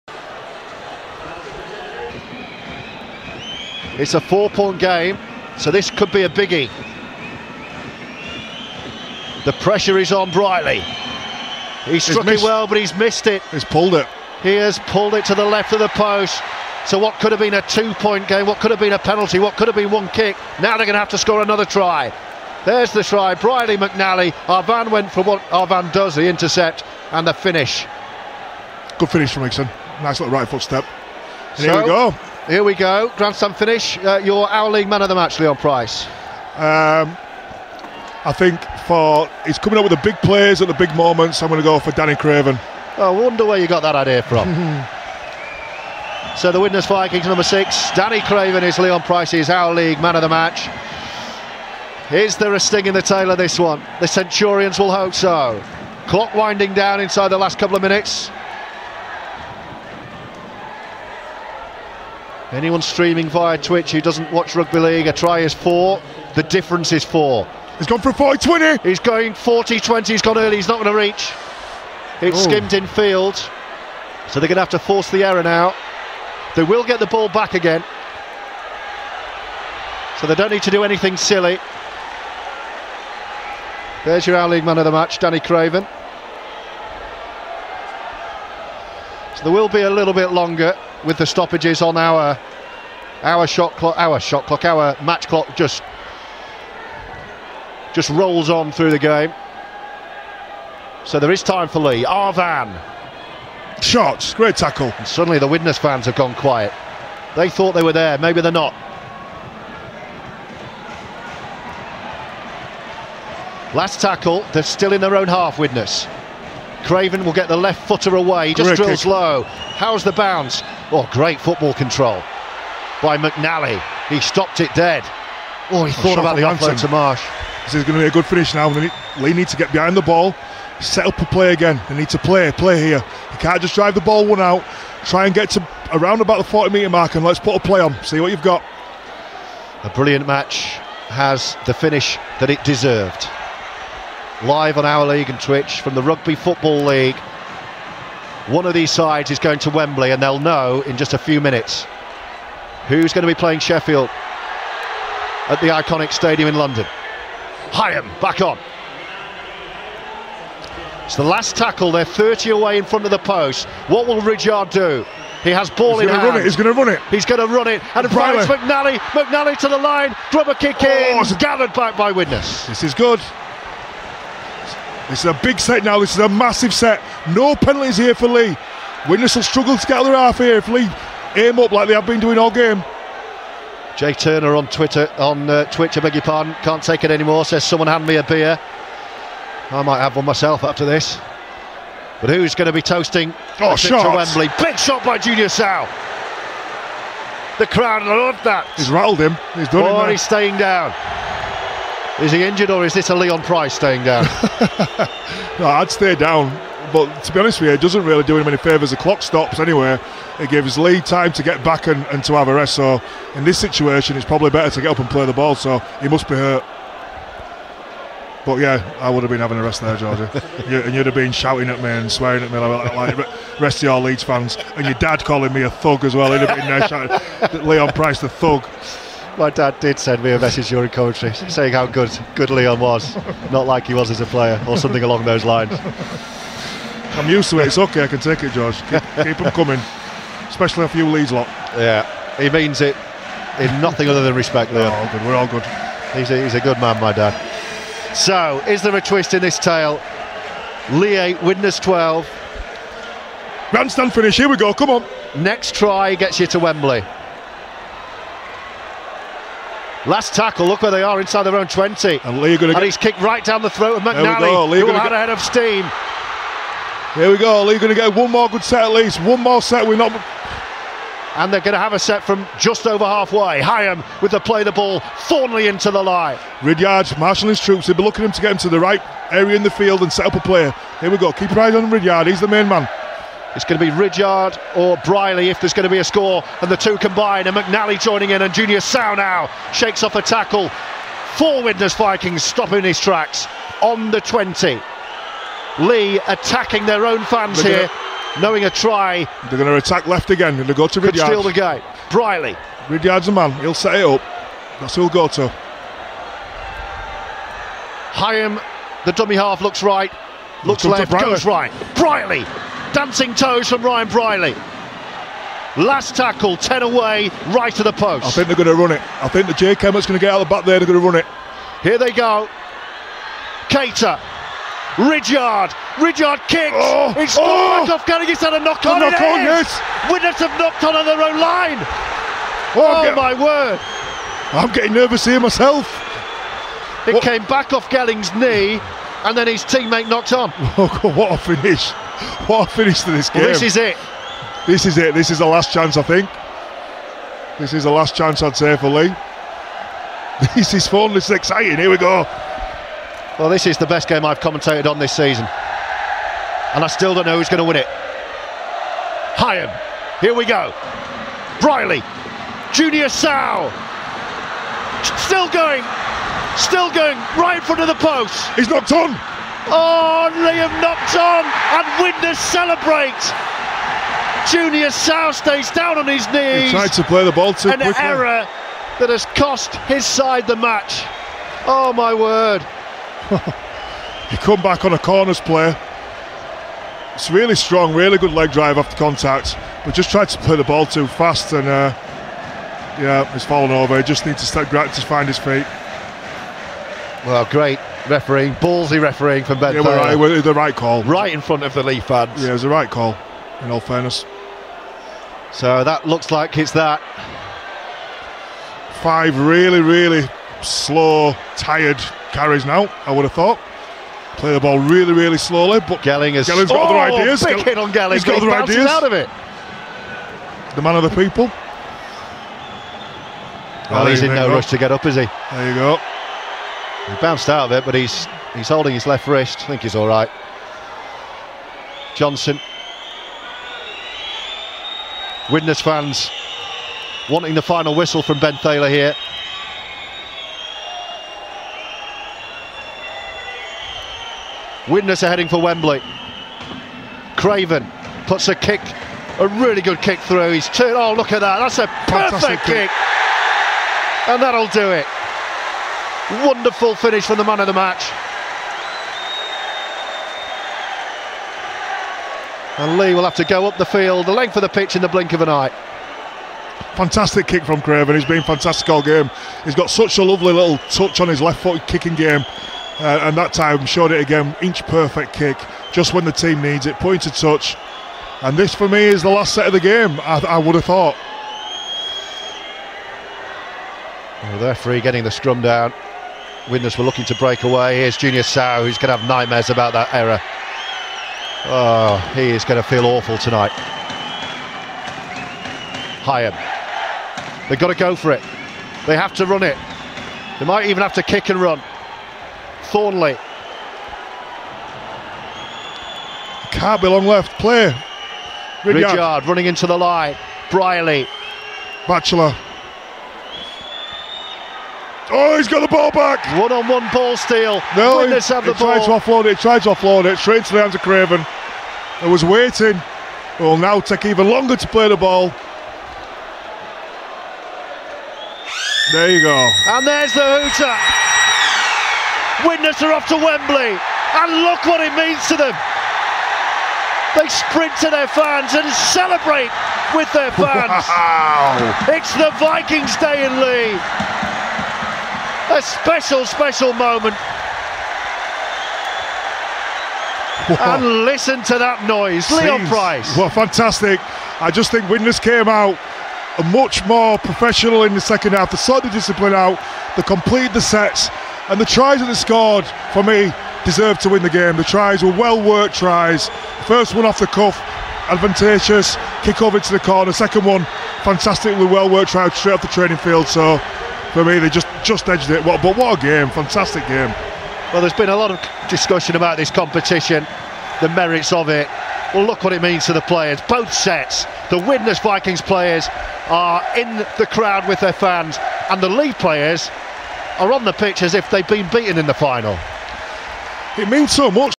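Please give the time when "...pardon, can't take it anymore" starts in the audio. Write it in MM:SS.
03:06.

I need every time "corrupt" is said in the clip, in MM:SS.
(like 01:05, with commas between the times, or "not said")
not said.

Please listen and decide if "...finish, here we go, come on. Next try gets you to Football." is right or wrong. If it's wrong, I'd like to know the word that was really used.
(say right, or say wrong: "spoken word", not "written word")
wrong: "Wembley", not "Football".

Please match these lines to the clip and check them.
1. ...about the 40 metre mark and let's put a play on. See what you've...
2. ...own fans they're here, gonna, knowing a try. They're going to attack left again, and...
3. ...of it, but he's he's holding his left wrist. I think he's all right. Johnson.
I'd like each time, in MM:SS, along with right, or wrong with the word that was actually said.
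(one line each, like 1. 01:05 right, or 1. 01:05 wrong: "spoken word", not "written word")
1. 02:16 right
2. 04:57 right
3. 07:07 right.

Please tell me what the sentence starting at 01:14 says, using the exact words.
So they're going to have to force the error now.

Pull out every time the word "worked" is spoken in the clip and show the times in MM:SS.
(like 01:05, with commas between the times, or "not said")
09:25, 09:32.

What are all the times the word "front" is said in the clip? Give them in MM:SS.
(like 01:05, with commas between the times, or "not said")
02:42, 06:07, 06:41.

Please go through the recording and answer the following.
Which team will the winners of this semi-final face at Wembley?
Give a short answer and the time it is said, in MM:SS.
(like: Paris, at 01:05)
Sheffield, at 02:33.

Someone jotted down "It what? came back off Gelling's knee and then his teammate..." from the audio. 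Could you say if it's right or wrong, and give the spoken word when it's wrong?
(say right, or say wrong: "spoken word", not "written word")
right.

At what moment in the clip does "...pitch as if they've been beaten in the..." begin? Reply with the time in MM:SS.
09:50.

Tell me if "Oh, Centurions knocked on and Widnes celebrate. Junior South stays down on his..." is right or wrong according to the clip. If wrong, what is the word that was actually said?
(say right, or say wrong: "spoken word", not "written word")
wrong: "Liam", not "Centurions".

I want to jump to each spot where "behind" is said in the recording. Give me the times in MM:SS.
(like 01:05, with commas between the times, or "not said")
02:09.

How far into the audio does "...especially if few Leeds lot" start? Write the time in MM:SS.
04:00.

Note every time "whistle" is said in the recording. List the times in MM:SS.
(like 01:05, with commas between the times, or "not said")
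07:17.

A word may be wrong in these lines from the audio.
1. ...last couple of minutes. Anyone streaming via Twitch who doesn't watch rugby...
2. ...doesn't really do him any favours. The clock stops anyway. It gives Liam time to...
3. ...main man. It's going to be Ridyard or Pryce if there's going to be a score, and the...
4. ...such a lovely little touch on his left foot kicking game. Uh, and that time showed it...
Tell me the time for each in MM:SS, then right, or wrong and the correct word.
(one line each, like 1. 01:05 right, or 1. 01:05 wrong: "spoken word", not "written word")
1. 00:57 right
2. 03:27 wrong: "Leigh", not "Liam"
3. 04:42 wrong: "Brierley", not "Pryce"
4. 07:49 right.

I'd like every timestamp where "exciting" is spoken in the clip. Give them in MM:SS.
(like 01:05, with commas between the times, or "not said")
05:51.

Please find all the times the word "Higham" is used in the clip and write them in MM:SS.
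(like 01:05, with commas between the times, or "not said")
02:37, 04:33, 05:08, 05:59, 08:16.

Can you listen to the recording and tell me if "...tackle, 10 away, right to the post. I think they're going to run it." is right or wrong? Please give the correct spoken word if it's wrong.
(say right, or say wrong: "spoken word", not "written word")
right.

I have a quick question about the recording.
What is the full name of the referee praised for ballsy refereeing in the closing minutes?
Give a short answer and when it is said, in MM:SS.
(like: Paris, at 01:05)
Ben Thaler, at 07:18.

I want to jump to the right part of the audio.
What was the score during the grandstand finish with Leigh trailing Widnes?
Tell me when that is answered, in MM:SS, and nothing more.
04:10.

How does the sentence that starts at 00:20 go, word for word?
Now they're going to have to score another try.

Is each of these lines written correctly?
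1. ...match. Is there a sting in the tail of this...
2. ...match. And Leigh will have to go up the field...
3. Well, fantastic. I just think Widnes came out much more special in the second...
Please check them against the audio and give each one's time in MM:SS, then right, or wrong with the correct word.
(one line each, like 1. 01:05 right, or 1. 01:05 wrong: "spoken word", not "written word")
1. 00:50 right
2. 07:37 right
3. 09:13 wrong: "professional", not "special".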